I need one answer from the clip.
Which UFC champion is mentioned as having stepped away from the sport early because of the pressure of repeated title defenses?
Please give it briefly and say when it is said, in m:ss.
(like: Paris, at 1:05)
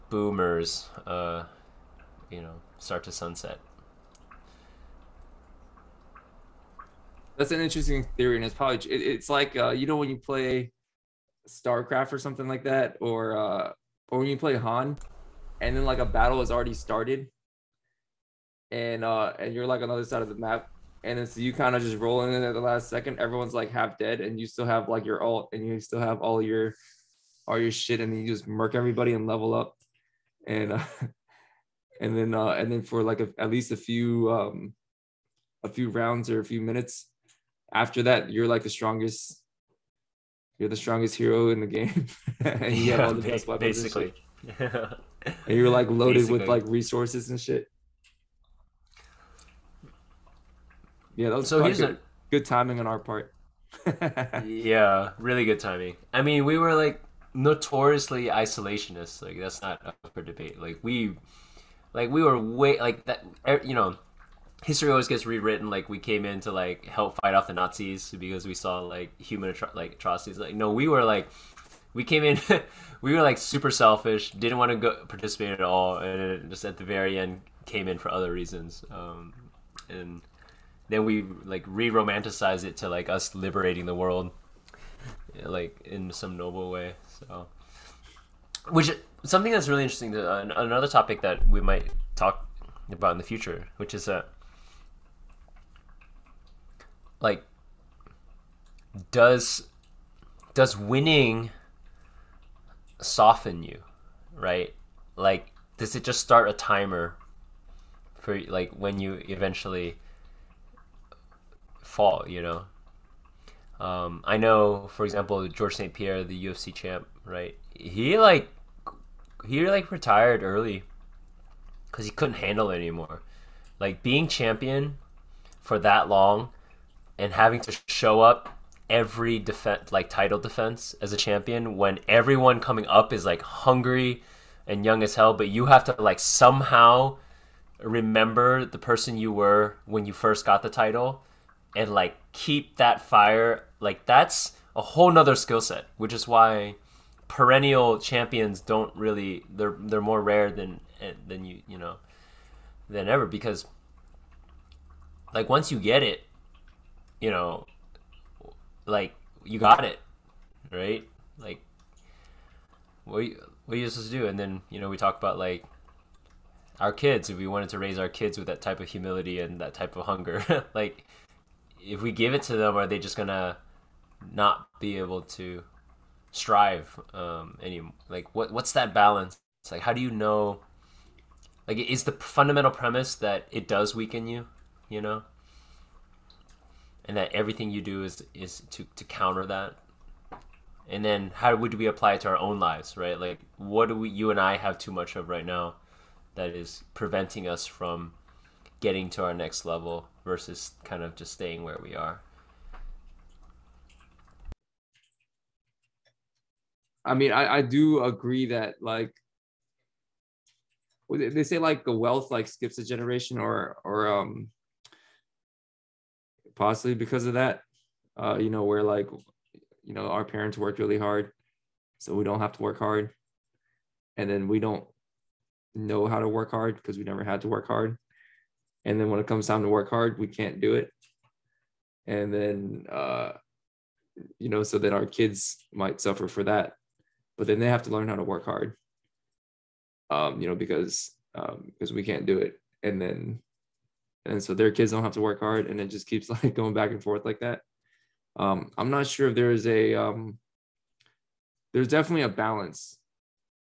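George St. Pierre, at 1:55.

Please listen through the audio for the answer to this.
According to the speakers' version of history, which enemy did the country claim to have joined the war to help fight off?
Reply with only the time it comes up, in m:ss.
1:07.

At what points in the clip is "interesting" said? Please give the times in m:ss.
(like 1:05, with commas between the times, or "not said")
0:07, 1:29.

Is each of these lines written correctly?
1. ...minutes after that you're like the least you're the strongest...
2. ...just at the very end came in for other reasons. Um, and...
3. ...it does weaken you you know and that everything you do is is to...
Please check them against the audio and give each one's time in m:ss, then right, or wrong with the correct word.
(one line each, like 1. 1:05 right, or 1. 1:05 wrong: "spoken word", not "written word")
1. 0:36 wrong: "strongest", not "least"
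2. 1:16 right
3. 3:03 right.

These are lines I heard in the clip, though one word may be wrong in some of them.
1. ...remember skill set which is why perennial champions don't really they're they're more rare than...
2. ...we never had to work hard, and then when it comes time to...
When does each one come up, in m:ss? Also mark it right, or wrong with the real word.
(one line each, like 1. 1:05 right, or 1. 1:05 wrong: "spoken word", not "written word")
1. 2:25 wrong: "nother", not "remember"
2. 3:46 right.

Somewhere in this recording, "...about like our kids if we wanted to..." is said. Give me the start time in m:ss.
2:45.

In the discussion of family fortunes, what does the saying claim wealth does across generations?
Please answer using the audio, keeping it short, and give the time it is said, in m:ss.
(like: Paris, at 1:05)
skips a generation, at 3:32.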